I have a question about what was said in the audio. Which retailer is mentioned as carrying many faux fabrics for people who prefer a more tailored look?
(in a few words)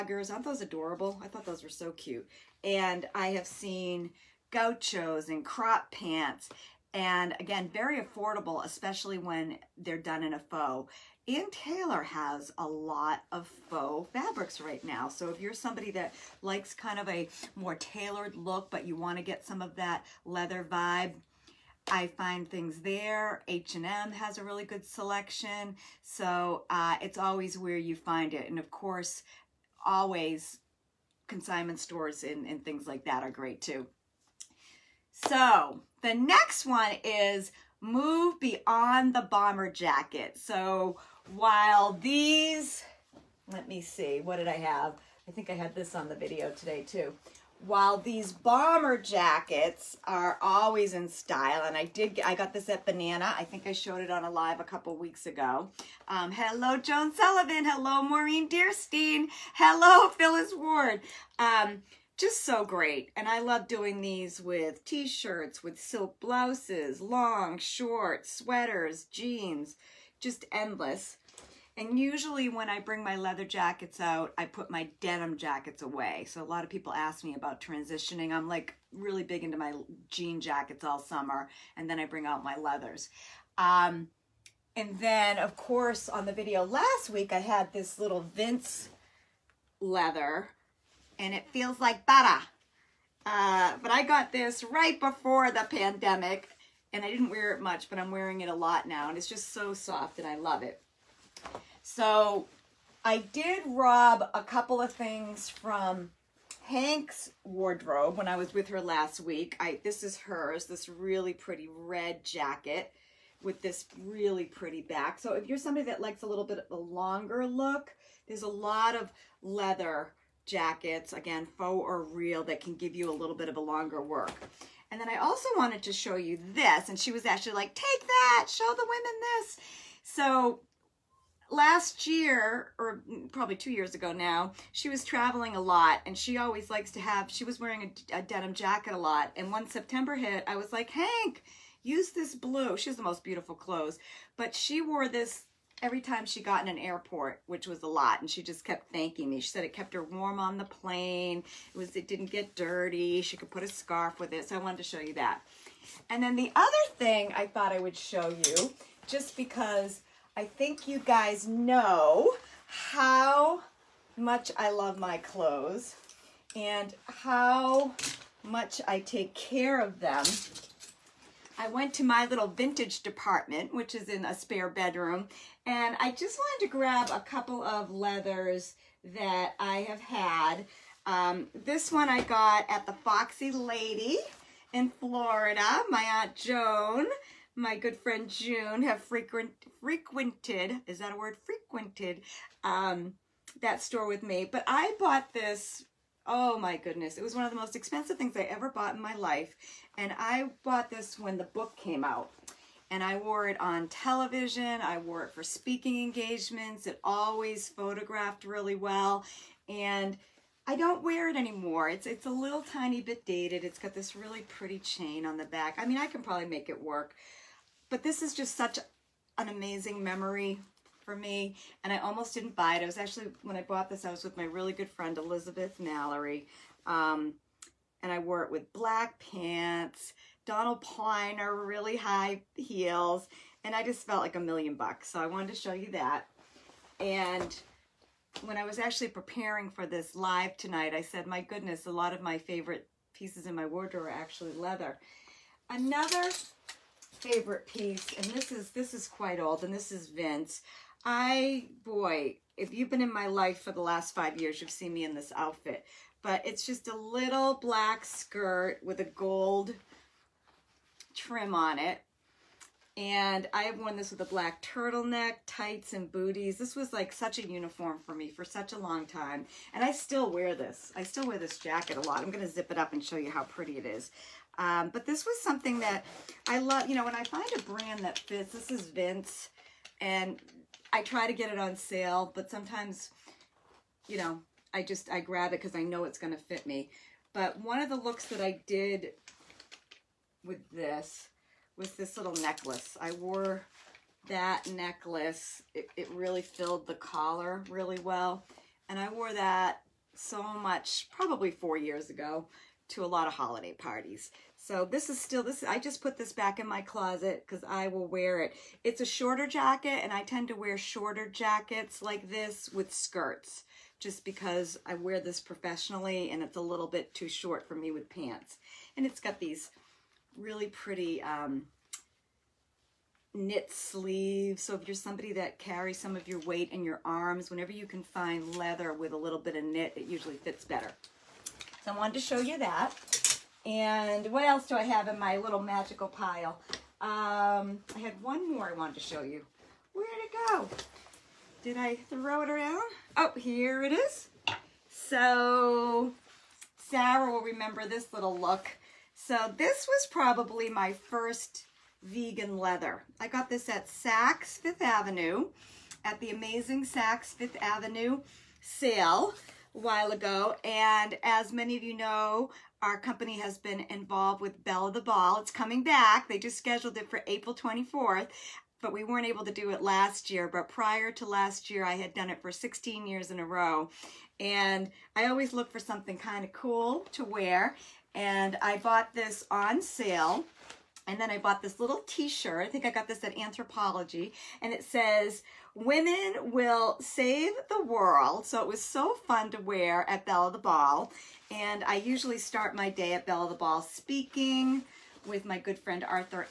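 Ann Taylor.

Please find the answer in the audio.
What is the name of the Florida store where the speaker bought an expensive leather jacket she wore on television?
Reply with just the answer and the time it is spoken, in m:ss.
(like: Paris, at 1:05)
Foxy Lady, at 3:02.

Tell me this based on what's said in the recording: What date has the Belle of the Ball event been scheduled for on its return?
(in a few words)
April 24.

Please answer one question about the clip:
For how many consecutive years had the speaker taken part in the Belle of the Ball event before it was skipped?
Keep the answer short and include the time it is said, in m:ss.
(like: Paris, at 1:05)
16, at 6:12.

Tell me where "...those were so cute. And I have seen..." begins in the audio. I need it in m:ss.
0:01.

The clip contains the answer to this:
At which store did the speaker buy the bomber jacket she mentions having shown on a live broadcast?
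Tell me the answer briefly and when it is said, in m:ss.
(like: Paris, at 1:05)
Banana, at 0:52.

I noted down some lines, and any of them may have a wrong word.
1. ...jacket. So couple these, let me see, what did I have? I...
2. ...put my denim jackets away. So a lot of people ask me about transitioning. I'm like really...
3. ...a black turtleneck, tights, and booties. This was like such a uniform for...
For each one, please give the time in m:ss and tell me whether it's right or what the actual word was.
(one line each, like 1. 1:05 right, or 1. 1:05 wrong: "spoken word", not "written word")
1. 0:39 wrong: "while", not "couple"
2. 1:14 right
3. 4:24 right.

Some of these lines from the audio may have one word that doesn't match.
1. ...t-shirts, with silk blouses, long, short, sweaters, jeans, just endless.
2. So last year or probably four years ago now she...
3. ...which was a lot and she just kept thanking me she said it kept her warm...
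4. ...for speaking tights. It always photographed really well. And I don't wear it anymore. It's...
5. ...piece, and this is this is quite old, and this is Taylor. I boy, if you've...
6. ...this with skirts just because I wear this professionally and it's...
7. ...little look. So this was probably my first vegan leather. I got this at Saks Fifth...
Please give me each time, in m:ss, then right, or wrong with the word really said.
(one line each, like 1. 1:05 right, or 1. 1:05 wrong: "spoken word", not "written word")
1. 1:04 right
2. 2:10 wrong: "two", not "four"
3. 2:27 right
4. 3:25 wrong: "engagements", not "tights"
5. 4:07 wrong: "Vince", not "Taylor"
6. 5:12 right
7. 5:48 right.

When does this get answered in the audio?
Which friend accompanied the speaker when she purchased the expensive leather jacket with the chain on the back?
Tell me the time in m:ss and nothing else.
3:45.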